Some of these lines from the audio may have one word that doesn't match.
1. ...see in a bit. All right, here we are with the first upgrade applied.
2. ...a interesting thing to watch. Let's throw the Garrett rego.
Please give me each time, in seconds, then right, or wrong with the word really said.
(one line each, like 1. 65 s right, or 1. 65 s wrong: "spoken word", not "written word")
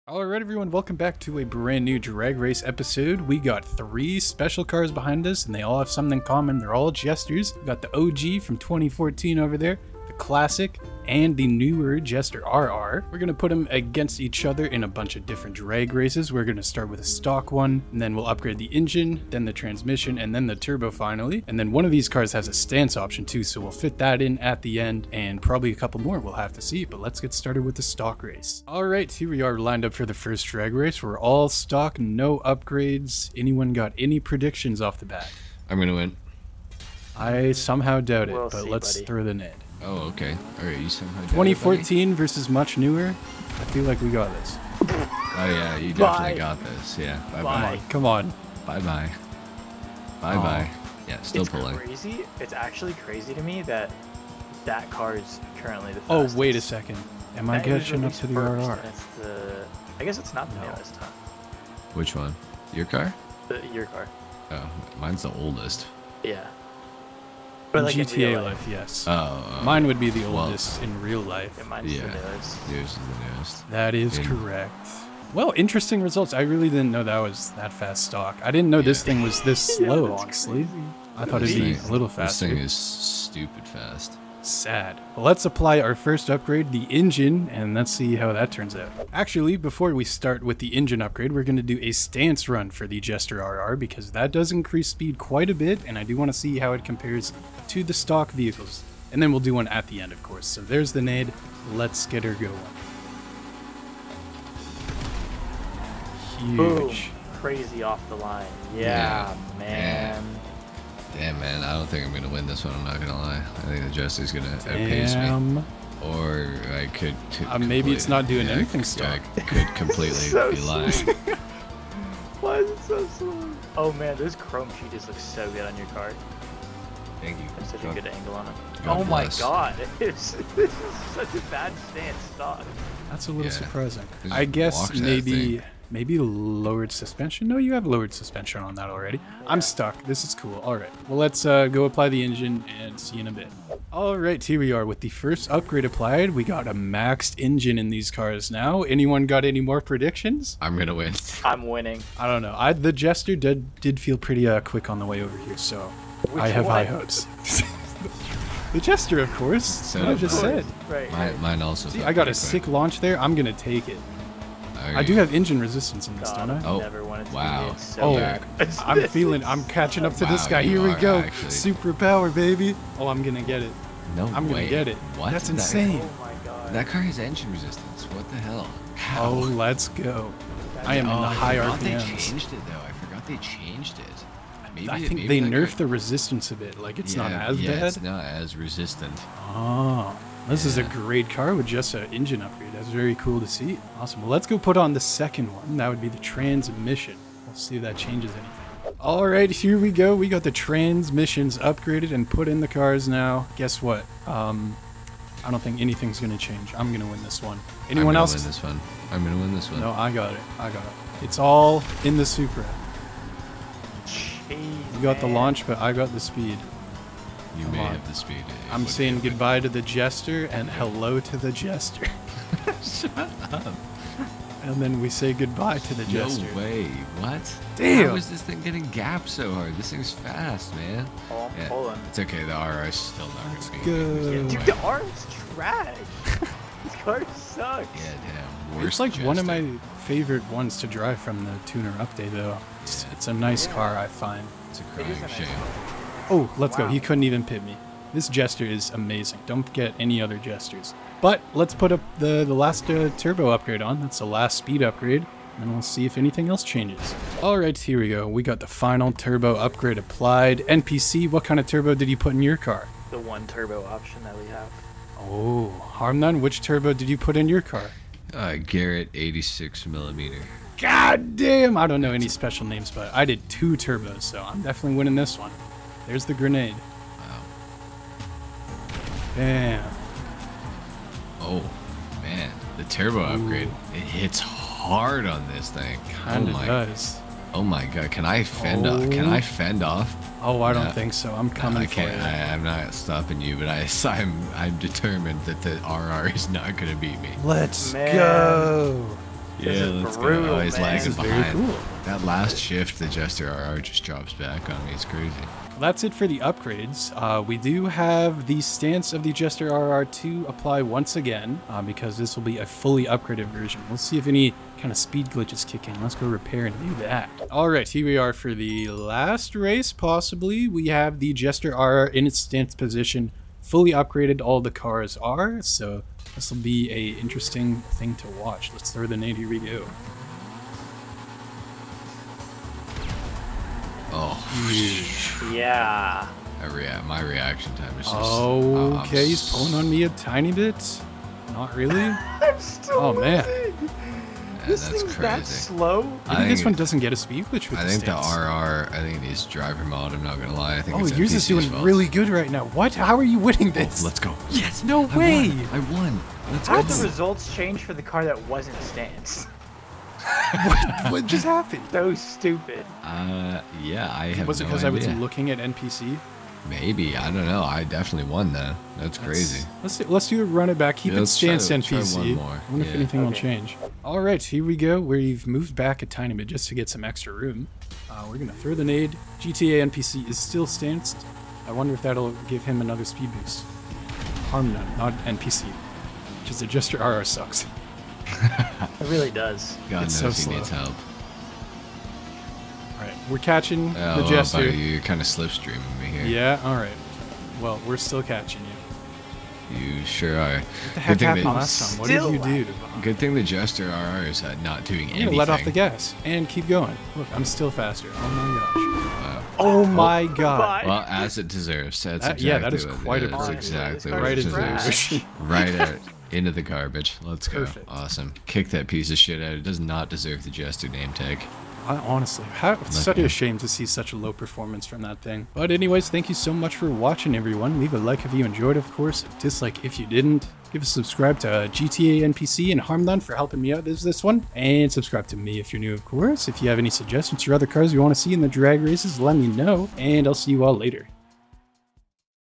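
1. 142 s right
2. 326 s wrong: "Navy", not "Garrett".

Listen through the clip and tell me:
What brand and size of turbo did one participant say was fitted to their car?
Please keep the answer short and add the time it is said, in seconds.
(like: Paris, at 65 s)
Garrett 86 millimeter, at 268 s.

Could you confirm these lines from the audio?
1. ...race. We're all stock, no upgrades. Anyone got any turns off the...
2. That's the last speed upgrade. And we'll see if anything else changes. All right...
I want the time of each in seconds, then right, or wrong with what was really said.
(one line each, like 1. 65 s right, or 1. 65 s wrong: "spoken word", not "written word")
1. 30 s wrong: "predictions", not "turns"
2. 253 s right.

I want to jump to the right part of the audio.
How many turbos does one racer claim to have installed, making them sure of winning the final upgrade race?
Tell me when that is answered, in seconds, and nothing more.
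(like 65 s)
273 s.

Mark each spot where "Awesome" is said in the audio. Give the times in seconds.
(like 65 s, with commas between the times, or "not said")
193 s, 417 s.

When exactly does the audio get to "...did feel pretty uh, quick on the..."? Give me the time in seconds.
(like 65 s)
153 s.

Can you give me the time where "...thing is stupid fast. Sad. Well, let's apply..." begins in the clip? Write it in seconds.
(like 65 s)
82 s.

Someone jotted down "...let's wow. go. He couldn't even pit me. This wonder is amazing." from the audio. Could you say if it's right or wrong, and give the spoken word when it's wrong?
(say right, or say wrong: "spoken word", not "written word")
wrong: "jester", not "wonder".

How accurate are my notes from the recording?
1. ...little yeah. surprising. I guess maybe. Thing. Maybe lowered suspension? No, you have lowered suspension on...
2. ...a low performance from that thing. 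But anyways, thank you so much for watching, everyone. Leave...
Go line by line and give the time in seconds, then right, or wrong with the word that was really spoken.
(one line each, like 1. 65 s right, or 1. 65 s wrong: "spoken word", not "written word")
1. 133 s right
2. 424 s right.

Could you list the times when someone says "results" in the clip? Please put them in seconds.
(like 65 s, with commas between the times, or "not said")
76 s, 357 s.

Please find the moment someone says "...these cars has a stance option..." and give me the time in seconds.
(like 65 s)
21 s.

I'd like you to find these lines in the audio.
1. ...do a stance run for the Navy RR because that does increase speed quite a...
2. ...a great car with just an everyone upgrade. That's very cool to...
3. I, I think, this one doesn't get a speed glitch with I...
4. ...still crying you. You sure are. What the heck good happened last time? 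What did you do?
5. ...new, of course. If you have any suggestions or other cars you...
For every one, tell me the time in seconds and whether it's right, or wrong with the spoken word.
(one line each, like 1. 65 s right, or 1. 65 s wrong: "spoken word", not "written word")
1. 91 s wrong: "Jester", not "Navy"
2. 190 s wrong: "engine", not "everyone"
3. 346 s right
4. 397 s wrong: "catching", not "crying"
5. 435 s right.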